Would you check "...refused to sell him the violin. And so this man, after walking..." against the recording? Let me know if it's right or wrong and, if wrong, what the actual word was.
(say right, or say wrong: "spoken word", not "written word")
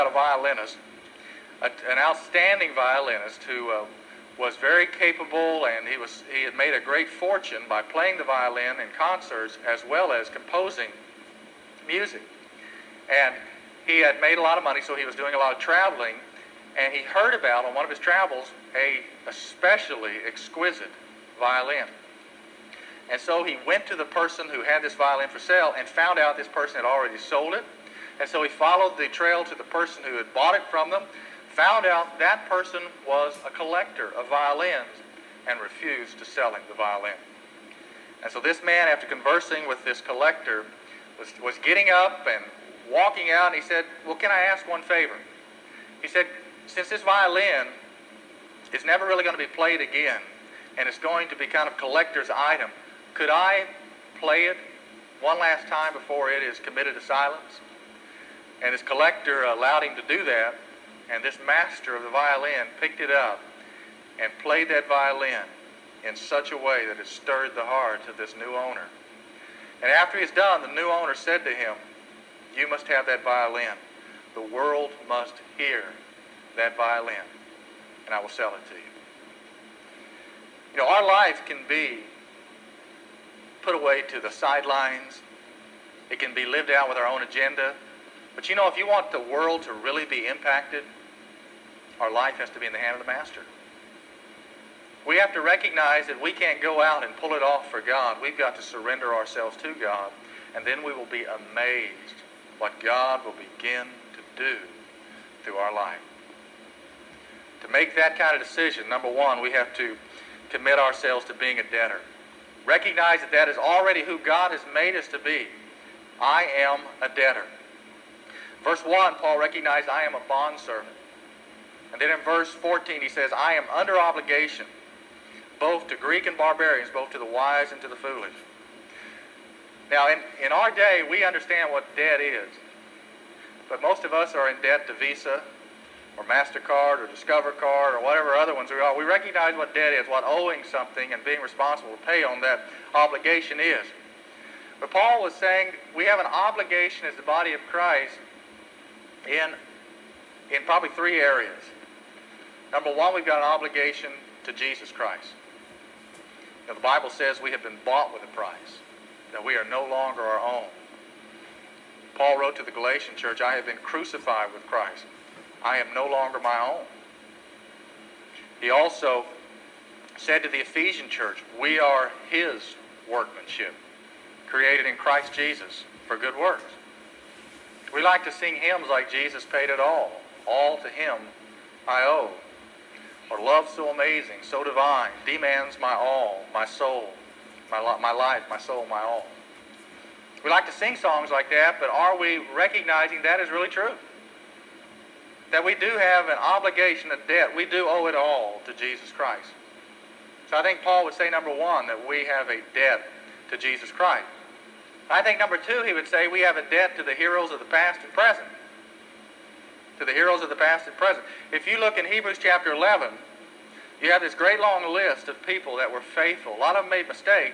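wrong: "conversing", not "walking".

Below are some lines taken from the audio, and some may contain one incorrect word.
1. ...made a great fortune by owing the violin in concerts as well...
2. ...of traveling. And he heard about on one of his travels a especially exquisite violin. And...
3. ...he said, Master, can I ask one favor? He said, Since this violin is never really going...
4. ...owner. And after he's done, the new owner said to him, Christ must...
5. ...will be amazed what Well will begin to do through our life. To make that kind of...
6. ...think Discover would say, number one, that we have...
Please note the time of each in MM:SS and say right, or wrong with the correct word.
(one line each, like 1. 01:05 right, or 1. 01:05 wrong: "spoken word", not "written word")
1. 00:06 wrong: "playing", not "owing"
2. 00:15 right
3. 00:43 wrong: "Well", not "Master"
4. 01:08 wrong: "You", not "Christ"
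5. 01:40 wrong: "God", not "Well"
6. 03:20 wrong: "Paul", not "Discover".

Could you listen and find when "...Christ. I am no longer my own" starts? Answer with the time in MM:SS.
02:44.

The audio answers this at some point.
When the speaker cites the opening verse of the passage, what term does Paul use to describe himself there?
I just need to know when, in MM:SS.
02:00.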